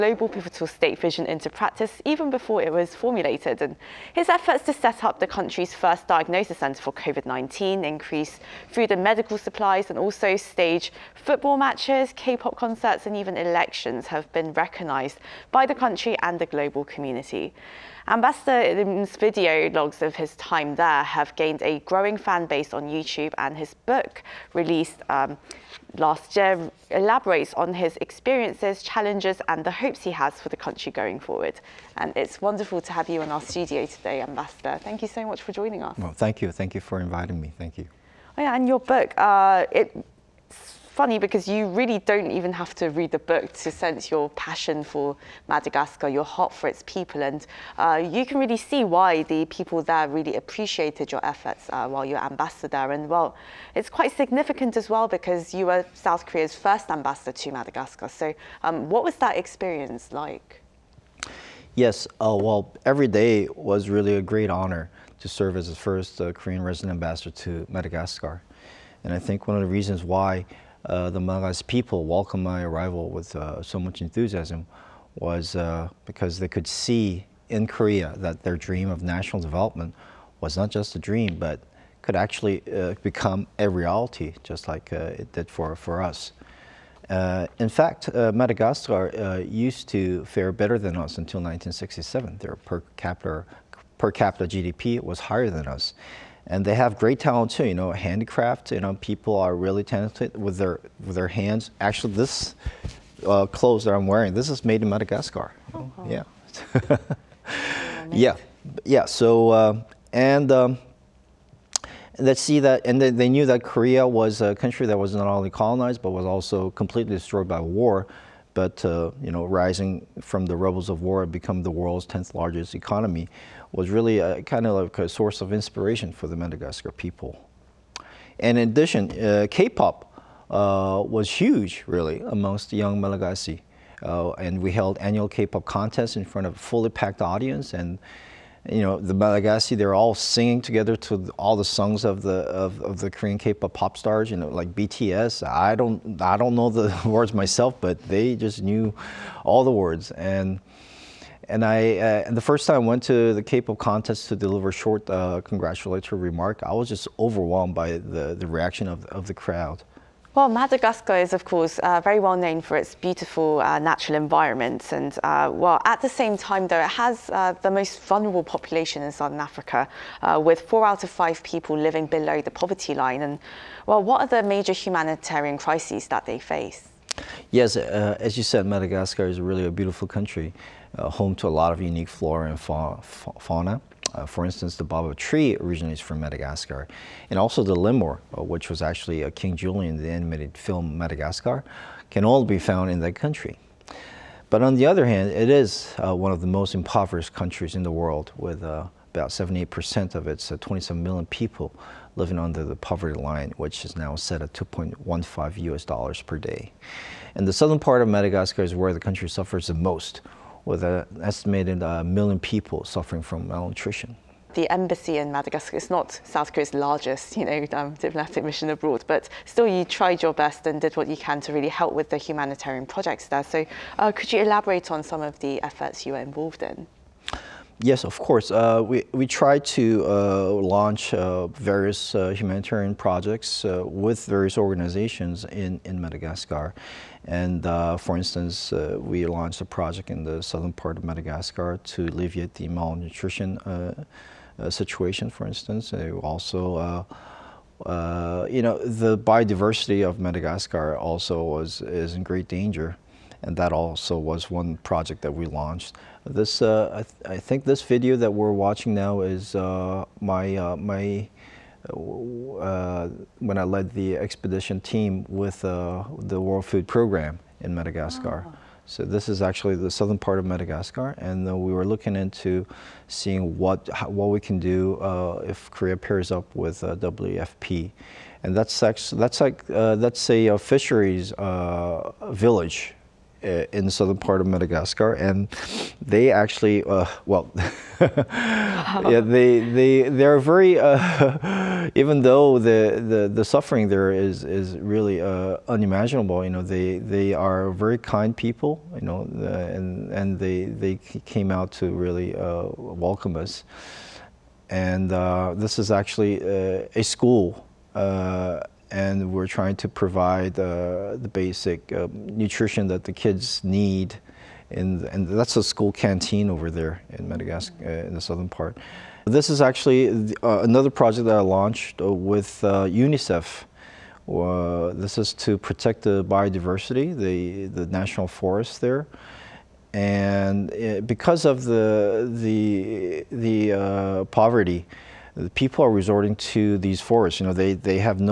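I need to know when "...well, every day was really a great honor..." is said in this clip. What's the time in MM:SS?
01:02.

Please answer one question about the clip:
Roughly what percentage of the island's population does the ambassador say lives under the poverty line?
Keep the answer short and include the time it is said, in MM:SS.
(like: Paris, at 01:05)
78%, at 03:19.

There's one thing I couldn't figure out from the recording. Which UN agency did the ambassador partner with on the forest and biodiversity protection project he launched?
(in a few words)
UNICEF.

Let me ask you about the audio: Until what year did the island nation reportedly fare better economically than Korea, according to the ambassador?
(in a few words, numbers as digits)
1967.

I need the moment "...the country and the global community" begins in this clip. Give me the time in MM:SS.
00:15.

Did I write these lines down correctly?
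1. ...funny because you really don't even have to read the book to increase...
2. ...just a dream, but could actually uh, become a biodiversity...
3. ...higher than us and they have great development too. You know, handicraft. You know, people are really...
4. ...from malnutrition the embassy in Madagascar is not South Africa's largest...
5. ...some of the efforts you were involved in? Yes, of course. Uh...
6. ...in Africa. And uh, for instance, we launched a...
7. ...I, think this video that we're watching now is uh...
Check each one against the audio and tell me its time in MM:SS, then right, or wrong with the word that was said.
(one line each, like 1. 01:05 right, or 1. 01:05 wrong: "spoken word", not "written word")
1. 00:40 wrong: "sense", not "increase"
2. 01:20 wrong: "reality", not "biodiversity"
3. 01:35 wrong: "talent", not "development"
4. 03:33 wrong: "Korea", not "Africa"
5. 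03:45 right
6. 03:55 wrong: "Madagascar", not "Africa"
7. 04:17 right.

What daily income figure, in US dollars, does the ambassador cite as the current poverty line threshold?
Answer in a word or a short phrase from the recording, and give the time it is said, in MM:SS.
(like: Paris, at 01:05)
$2.15, at 03:24.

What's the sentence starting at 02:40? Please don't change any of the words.
Well, Madagascar is, of course, uh, very well known for its beautiful uh, natural environment.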